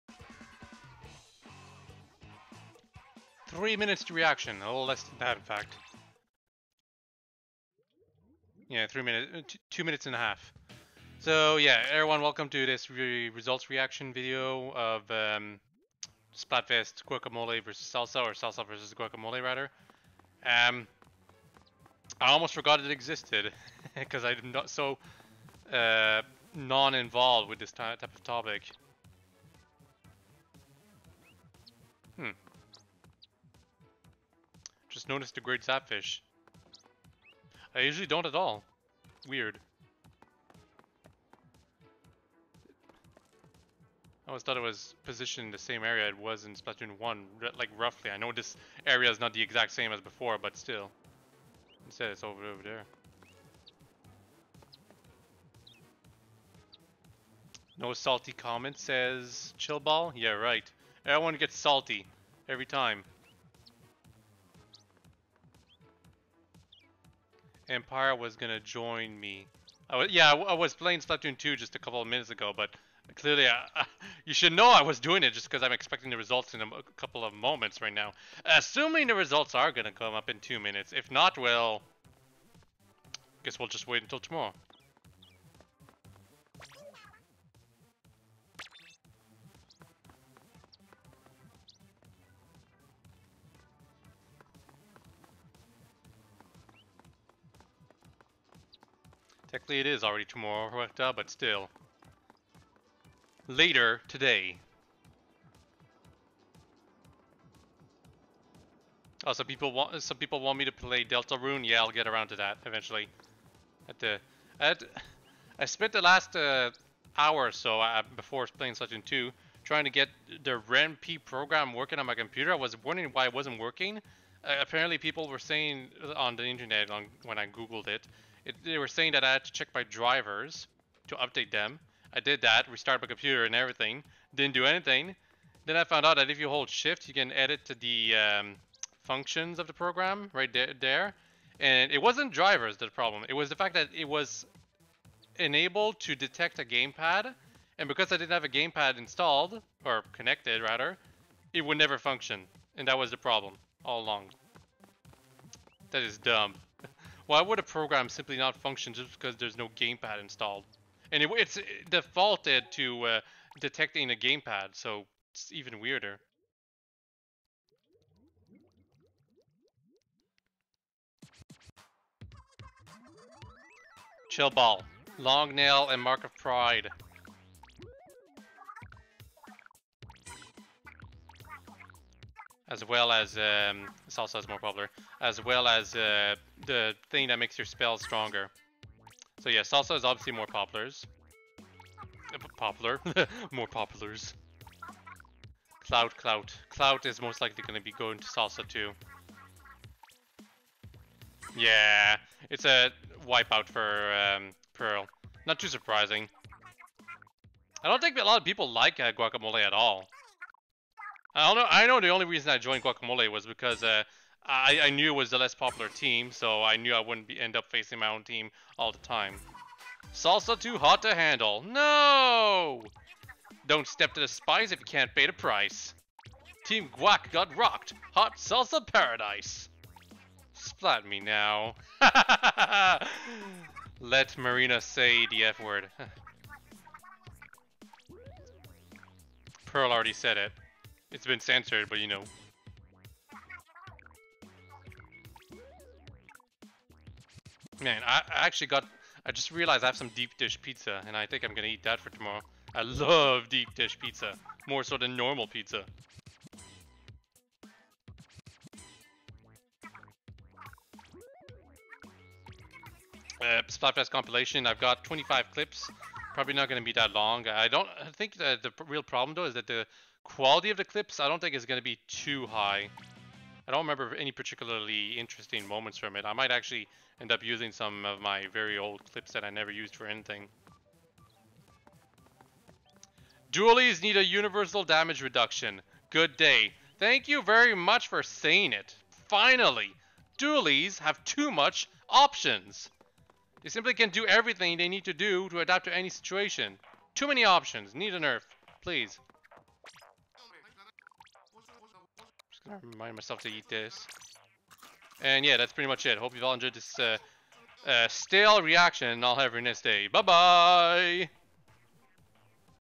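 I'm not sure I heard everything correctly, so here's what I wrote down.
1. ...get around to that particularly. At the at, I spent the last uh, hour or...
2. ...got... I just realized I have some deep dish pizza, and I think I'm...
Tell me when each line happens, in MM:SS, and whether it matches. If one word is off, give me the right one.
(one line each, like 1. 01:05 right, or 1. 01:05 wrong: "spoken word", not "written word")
1. 01:51 wrong: "eventually", not "particularly"
2. 04:08 right.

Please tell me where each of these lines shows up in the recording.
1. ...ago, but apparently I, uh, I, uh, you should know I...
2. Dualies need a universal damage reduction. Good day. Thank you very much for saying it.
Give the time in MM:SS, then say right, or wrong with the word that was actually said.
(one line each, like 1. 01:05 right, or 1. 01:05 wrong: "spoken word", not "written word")
1. 01:12 wrong: "clearly", not "apparently"
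2. 04:43 right.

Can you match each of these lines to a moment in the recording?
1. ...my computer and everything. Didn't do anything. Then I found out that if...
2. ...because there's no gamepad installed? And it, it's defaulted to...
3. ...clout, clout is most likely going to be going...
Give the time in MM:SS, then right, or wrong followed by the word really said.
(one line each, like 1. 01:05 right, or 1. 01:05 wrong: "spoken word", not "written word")
1. 02:13 right
2. 02:39 right
3. 03:16 right.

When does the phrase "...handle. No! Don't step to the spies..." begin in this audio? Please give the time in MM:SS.
03:41.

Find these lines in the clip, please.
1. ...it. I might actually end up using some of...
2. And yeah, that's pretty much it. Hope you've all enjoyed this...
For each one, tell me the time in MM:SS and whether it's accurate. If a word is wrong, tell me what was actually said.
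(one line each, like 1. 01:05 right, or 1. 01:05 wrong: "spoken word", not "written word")
1. 04:36 right
2. 05:05 right.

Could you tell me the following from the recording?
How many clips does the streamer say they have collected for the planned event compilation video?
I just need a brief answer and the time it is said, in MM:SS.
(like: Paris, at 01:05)
25, at 04:25.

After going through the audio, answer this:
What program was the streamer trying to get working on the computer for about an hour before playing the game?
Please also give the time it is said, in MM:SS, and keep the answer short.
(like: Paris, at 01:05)
Ren'Py, at 02:00.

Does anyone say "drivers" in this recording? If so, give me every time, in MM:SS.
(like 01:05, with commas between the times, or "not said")
02:09, 02:22.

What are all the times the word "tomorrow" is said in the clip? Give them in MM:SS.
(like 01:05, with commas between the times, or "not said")
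01:24, 01:40, 04:12.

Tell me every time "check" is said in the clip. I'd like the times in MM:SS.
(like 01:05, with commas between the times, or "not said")
02:09.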